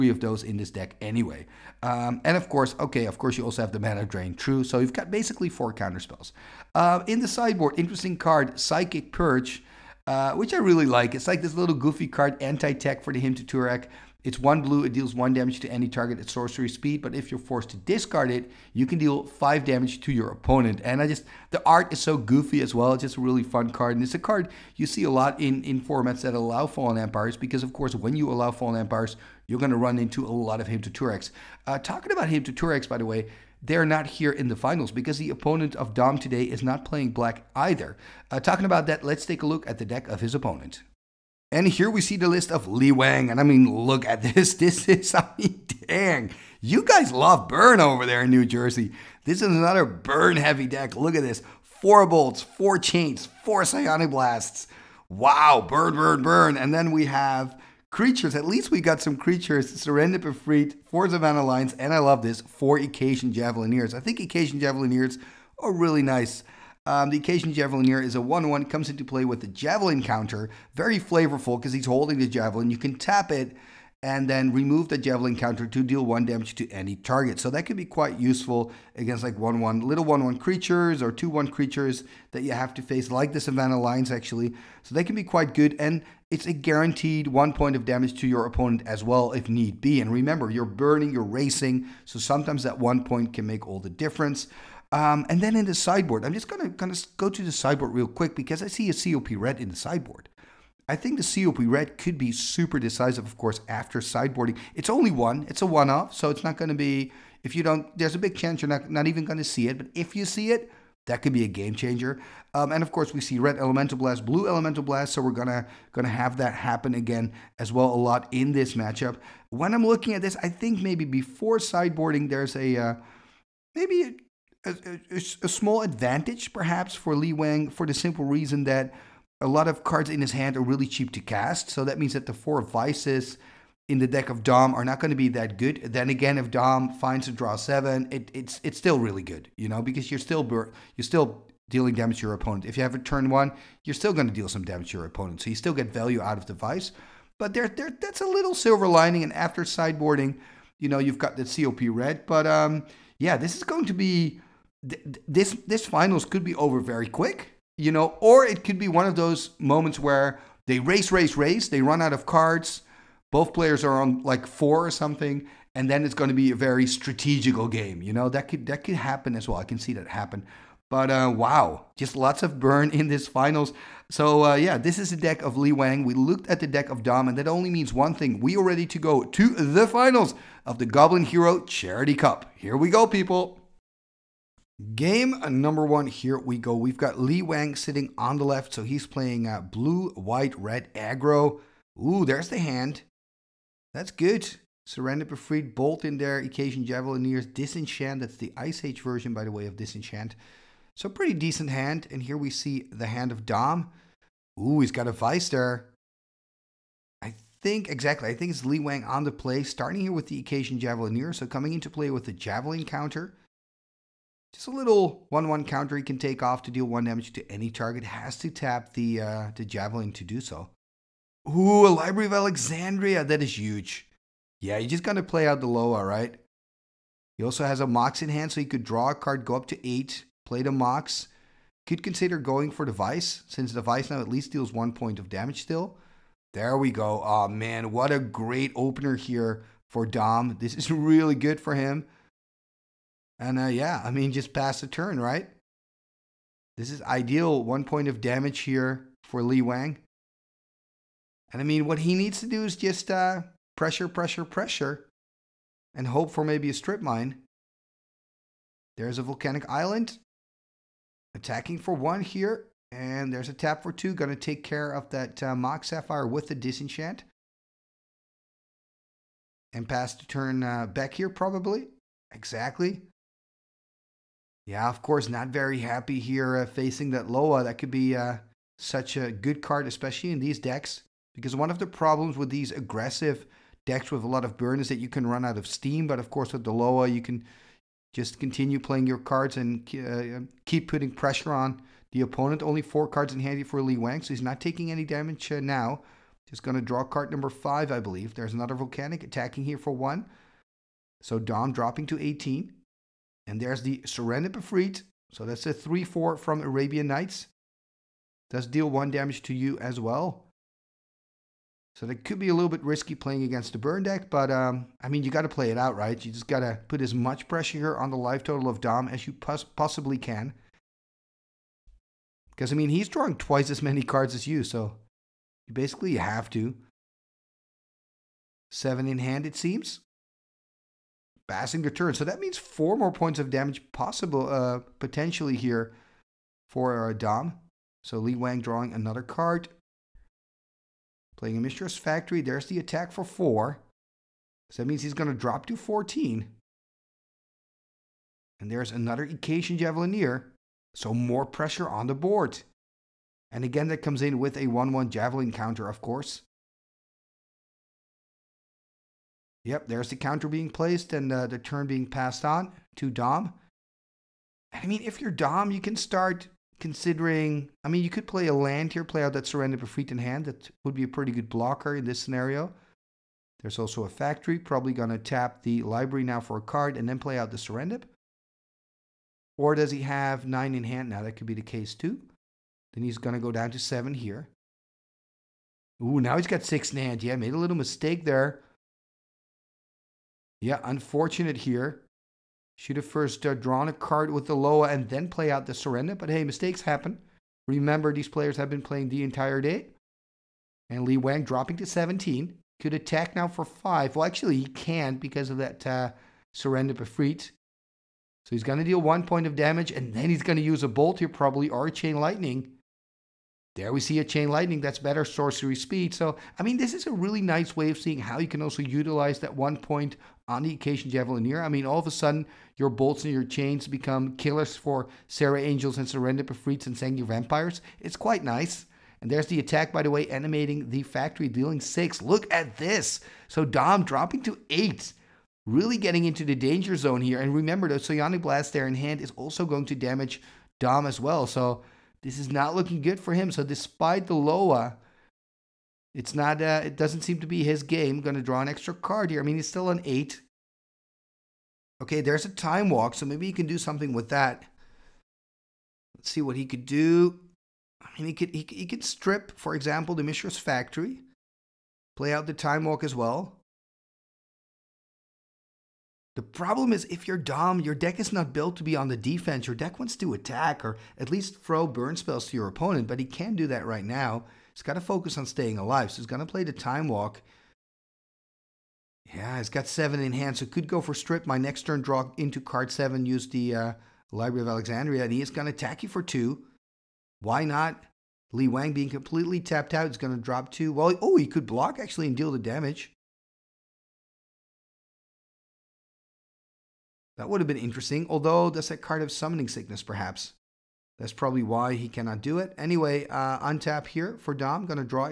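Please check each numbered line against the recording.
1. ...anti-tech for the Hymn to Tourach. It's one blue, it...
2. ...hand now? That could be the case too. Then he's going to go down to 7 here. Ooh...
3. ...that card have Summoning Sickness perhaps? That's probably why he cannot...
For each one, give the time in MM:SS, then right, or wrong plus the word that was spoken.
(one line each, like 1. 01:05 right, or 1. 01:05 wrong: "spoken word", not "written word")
1. 00:12 right
2. 06:20 right
3. 08:18 right.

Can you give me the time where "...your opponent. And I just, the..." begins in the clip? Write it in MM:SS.
00:20.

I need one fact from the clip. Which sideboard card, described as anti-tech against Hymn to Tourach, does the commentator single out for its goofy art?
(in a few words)
Psychic Purge.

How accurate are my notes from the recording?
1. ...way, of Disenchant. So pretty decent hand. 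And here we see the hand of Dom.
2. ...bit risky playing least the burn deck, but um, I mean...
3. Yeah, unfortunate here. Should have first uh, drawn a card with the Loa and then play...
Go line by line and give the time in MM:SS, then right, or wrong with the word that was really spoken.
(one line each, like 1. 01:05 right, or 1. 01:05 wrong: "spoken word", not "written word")
1. 03:19 right
2. 05:12 wrong: "against", not "least"
3. 06:30 right.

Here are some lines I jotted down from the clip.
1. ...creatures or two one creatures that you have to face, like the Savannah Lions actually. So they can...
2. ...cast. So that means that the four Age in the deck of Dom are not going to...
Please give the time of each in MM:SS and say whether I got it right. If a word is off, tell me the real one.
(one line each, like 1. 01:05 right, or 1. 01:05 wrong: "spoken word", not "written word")
1. 01:20 right
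2. 02:11 wrong: "Vises", not "Age".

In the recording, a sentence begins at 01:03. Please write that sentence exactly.
I think Icatian Javelineers are really nice.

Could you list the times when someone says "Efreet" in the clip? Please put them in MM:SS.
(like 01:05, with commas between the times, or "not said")
01:00, 03:15, 05:04, 06:09, 06:46, 07:06.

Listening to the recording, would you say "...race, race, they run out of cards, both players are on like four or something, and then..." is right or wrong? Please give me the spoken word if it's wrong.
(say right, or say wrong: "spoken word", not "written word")
right.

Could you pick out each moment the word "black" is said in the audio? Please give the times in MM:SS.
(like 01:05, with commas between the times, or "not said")
00:37.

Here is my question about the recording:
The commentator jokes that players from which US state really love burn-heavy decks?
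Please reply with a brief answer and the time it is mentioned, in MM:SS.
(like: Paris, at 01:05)
New Jersey, at 00:48.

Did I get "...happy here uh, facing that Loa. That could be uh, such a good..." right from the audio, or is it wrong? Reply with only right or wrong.
right.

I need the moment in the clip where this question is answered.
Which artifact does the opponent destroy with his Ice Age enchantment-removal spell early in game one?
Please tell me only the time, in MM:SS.
04:25.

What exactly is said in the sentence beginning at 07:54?
He's got to focus on staying alive.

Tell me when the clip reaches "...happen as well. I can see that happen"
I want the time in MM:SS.
02:48.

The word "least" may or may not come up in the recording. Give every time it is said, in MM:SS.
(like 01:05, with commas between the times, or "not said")
00:58, 03:54, 07:51.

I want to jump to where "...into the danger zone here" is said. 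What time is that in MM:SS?
07:16.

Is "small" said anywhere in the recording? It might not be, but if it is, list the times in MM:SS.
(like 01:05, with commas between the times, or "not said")
02:05.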